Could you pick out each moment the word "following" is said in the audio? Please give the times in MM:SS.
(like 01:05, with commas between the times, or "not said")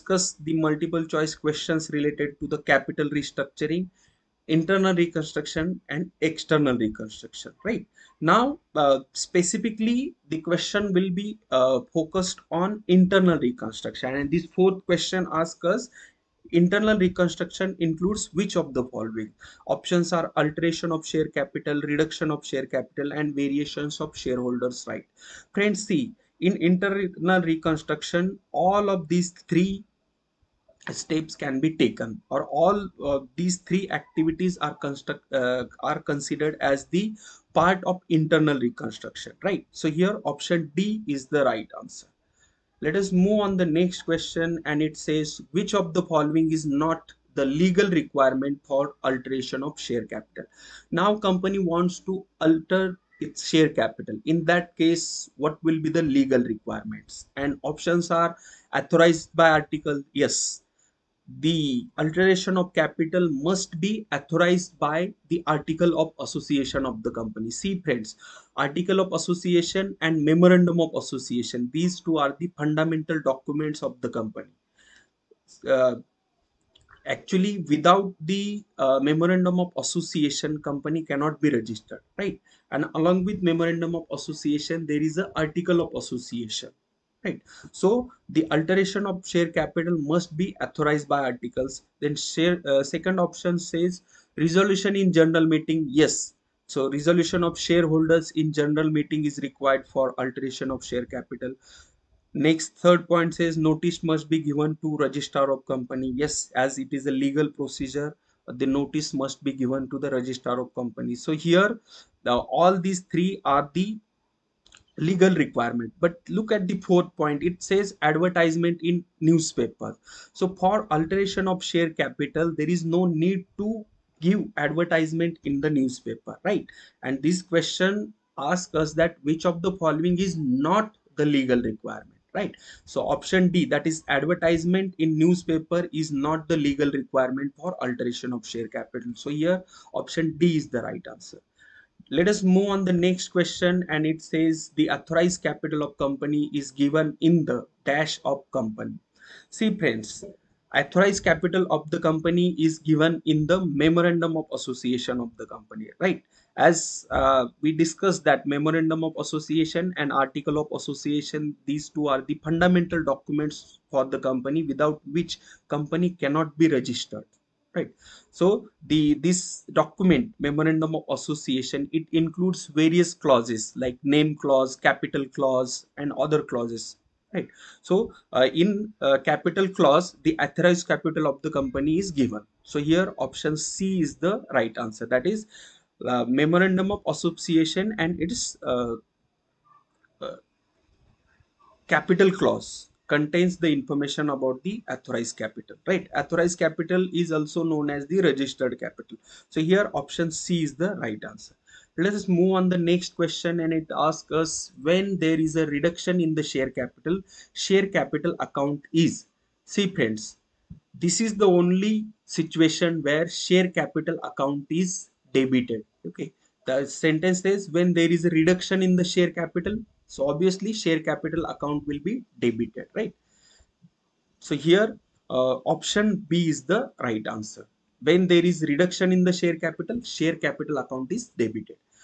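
00:18, 00:46, 02:09.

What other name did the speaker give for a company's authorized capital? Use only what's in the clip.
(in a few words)
Registered capital.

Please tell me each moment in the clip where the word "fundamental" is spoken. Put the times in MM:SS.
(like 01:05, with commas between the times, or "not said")
01:12, 02:42.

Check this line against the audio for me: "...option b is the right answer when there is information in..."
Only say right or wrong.
wrong.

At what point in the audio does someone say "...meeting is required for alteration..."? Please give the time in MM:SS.
01:38.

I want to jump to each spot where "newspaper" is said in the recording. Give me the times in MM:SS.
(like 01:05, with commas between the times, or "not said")
01:59, 02:05, 02:15.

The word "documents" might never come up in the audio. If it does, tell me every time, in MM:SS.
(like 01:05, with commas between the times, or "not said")
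01:13, 02:43, 02:49.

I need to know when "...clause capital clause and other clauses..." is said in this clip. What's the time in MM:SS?
02:54.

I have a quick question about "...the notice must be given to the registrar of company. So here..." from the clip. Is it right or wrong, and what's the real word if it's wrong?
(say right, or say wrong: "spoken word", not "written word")
right.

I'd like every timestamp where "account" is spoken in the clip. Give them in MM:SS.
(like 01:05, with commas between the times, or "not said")
03:28, 03:34, 03:41, 03:50.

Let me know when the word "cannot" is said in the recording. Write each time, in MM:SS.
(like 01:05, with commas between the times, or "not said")
01:21, 02:46.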